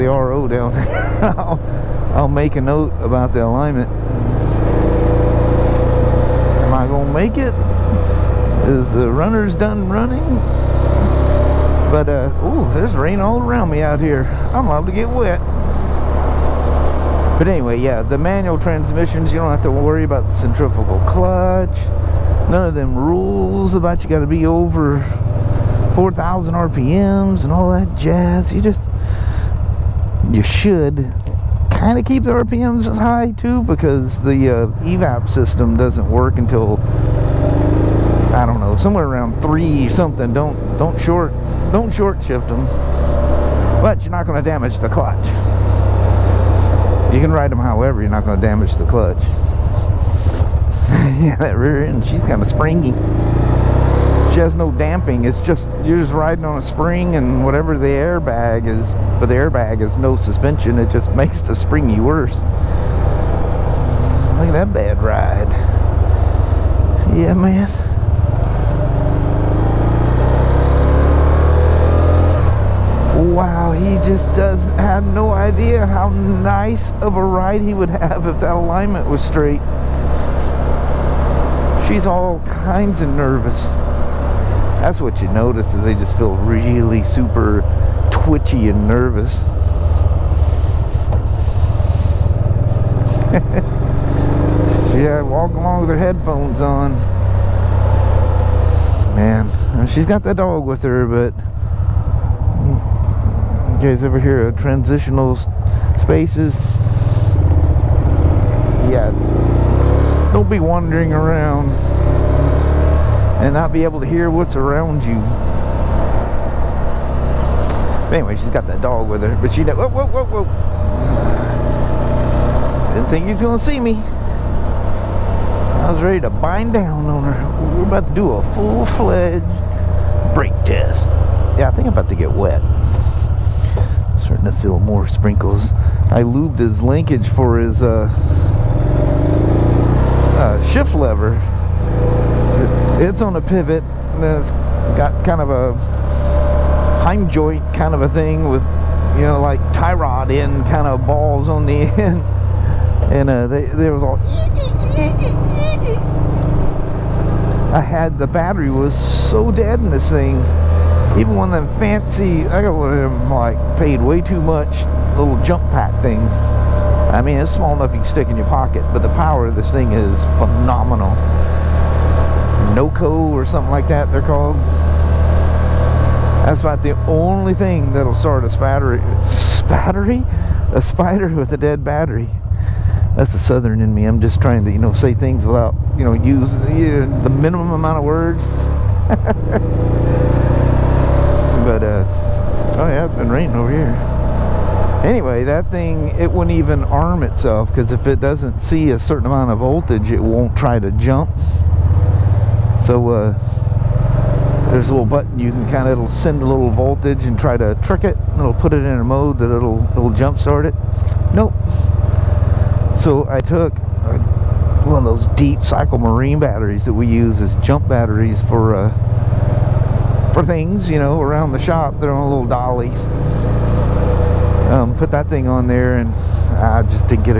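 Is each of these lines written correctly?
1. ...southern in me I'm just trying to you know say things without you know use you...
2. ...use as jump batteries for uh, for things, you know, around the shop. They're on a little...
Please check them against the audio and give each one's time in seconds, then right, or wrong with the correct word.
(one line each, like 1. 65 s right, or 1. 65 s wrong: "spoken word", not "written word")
1. 183 s right
2. 217 s right.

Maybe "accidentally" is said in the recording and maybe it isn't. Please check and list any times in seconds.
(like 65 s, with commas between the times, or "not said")
not said.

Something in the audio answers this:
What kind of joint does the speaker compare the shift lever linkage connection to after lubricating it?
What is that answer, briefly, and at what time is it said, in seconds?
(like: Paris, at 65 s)
Heim joint, at 147 s.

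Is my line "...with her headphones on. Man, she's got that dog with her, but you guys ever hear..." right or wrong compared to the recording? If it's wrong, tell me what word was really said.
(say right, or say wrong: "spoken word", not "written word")
right.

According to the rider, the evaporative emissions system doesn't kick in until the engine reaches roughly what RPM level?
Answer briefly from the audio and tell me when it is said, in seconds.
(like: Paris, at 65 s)
3,000, at 39 s.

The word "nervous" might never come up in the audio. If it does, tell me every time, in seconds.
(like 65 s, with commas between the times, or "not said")
83 s, 88 s.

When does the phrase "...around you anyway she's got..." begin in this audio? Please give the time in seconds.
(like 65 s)
114 s.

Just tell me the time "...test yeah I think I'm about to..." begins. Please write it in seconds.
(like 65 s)
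130 s.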